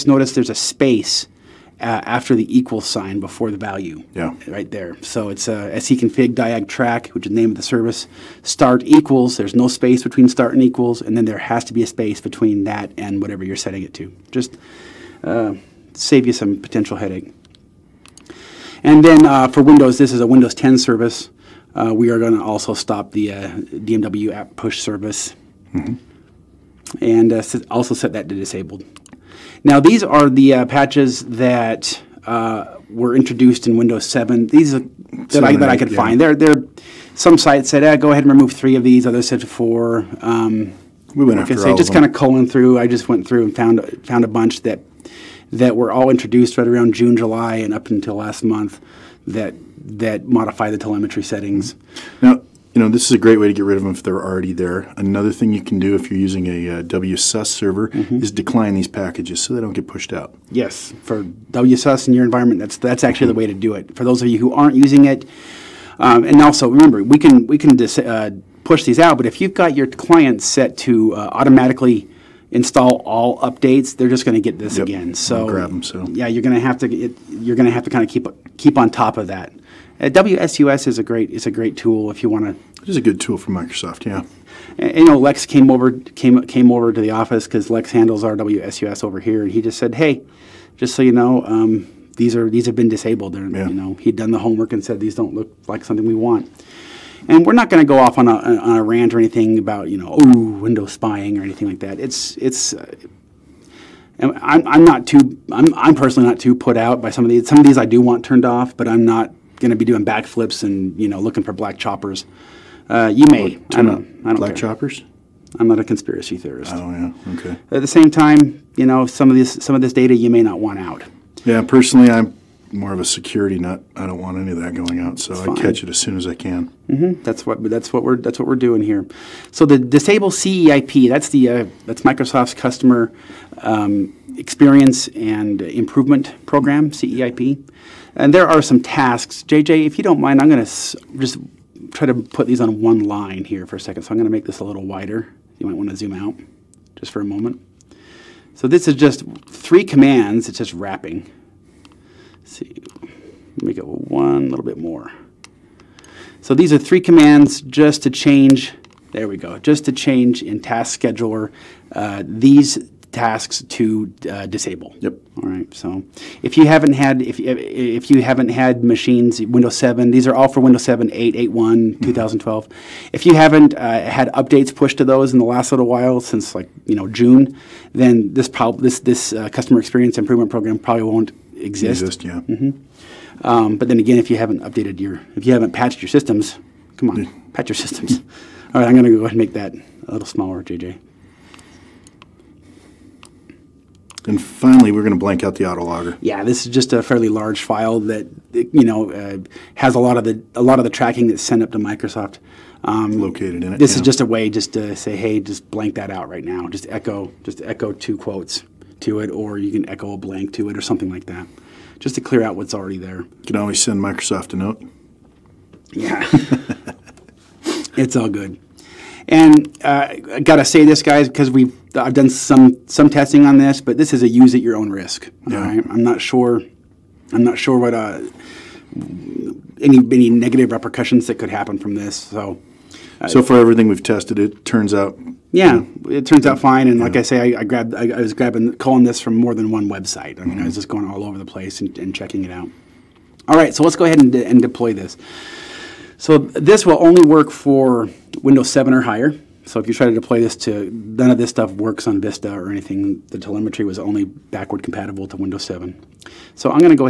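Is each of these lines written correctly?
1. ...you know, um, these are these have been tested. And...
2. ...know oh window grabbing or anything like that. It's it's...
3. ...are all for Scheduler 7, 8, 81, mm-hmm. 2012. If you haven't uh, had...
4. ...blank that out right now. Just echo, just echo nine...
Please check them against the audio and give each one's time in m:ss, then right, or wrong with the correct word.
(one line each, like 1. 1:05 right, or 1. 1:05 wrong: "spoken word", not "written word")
1. 1:31 wrong: "disabled", not "tested"
2. 1:39 wrong: "spying", not "grabbing"
3. 2:50 wrong: "Windows", not "Scheduler"
4. 3:25 wrong: "two", not "nine".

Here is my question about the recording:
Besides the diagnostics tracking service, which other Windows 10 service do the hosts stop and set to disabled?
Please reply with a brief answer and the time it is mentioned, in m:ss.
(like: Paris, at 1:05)
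DMW app push service, at 0:23.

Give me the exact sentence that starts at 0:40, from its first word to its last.
Um, we went like after all just kind of culling through.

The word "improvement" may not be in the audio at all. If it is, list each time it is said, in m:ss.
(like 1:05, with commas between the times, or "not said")
2:15, 3:00.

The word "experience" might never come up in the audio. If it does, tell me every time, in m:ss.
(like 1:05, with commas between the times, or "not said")
2:14, 2:59.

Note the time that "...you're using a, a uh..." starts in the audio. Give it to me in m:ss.
0:56.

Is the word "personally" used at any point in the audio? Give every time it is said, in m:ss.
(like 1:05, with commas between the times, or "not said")
1:45, 2:01.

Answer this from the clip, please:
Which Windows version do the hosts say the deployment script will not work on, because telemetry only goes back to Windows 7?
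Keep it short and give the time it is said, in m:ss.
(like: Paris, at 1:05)
Vista, at 4:12.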